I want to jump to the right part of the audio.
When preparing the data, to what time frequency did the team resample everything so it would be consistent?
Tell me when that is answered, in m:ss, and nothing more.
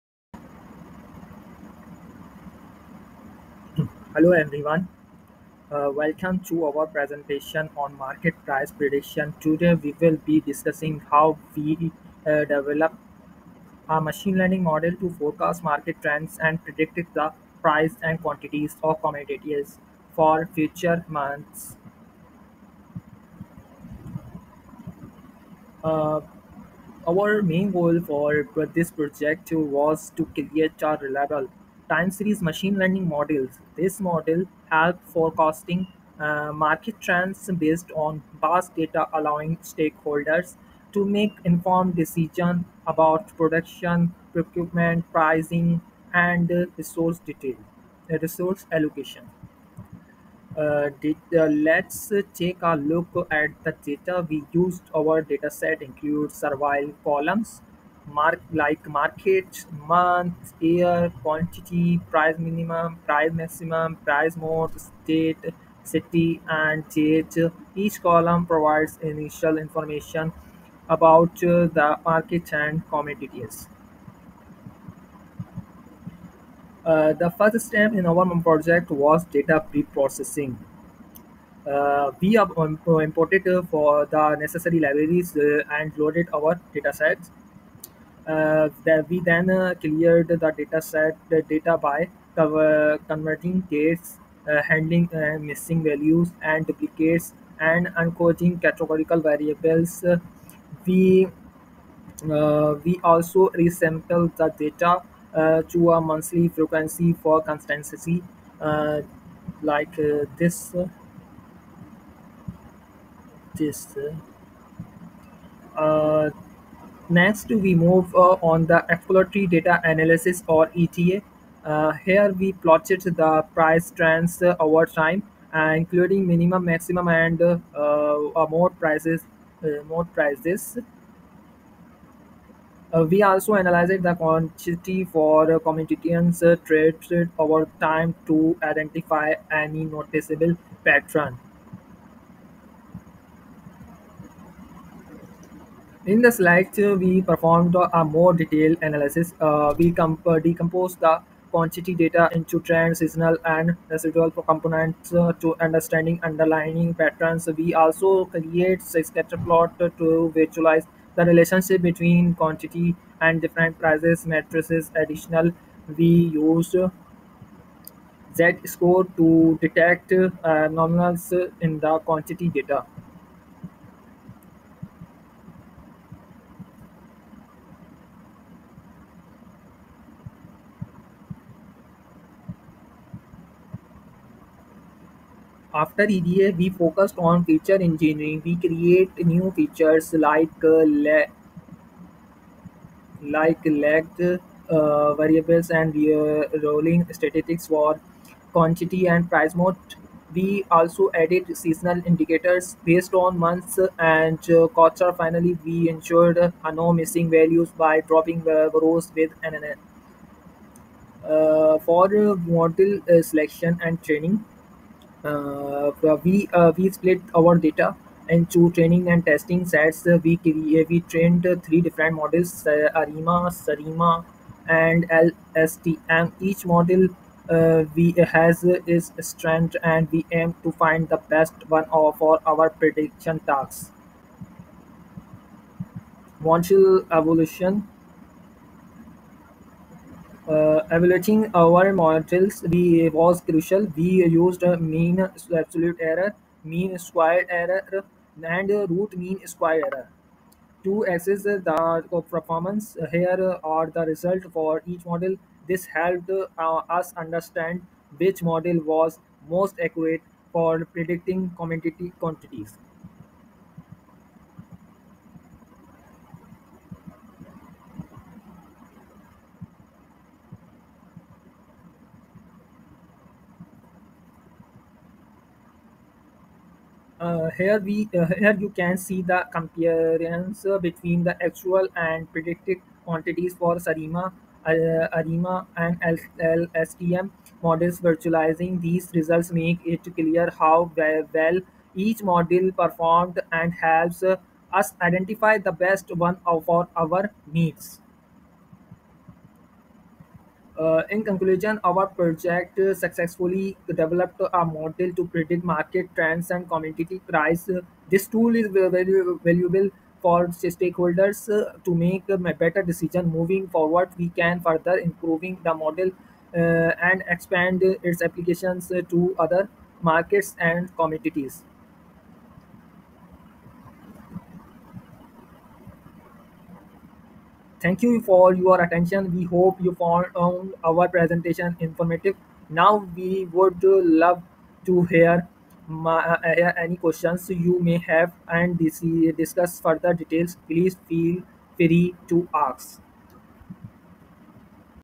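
1:45.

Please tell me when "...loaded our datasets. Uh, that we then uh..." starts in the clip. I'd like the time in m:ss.
1:25.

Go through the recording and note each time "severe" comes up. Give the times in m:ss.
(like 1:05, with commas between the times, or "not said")
not said.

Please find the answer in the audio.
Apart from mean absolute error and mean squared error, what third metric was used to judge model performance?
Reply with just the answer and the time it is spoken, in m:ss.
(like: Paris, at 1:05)
Root mean squared error, at 4:08.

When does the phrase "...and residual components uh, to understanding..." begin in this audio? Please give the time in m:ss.
2:33.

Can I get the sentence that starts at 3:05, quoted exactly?
after EDA, we focused on feature engineering.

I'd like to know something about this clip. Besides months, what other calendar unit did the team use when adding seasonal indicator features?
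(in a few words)
Quarter.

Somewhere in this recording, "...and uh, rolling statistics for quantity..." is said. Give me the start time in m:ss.
3:15.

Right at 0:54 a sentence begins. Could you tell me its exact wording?
Our data set includes survival columns, mark like market, month, year, quantity, price minimum, price maximum, price mode, state, city, and date.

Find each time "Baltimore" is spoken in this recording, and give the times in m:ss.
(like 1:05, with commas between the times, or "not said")
not said.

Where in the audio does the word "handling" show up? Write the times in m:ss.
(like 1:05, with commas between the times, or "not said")
1:34.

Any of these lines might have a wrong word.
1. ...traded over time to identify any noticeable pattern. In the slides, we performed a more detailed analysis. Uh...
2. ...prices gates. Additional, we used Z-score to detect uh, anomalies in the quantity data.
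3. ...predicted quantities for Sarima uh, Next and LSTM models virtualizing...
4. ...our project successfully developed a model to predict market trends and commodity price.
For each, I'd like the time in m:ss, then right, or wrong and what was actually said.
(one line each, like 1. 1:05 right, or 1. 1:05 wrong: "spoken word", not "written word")
1. 2:16 right
2. 2:43 wrong: "matrices", not "gates"
3. 4:42 wrong: "ARIMA", not "Next"
4. 5:01 right.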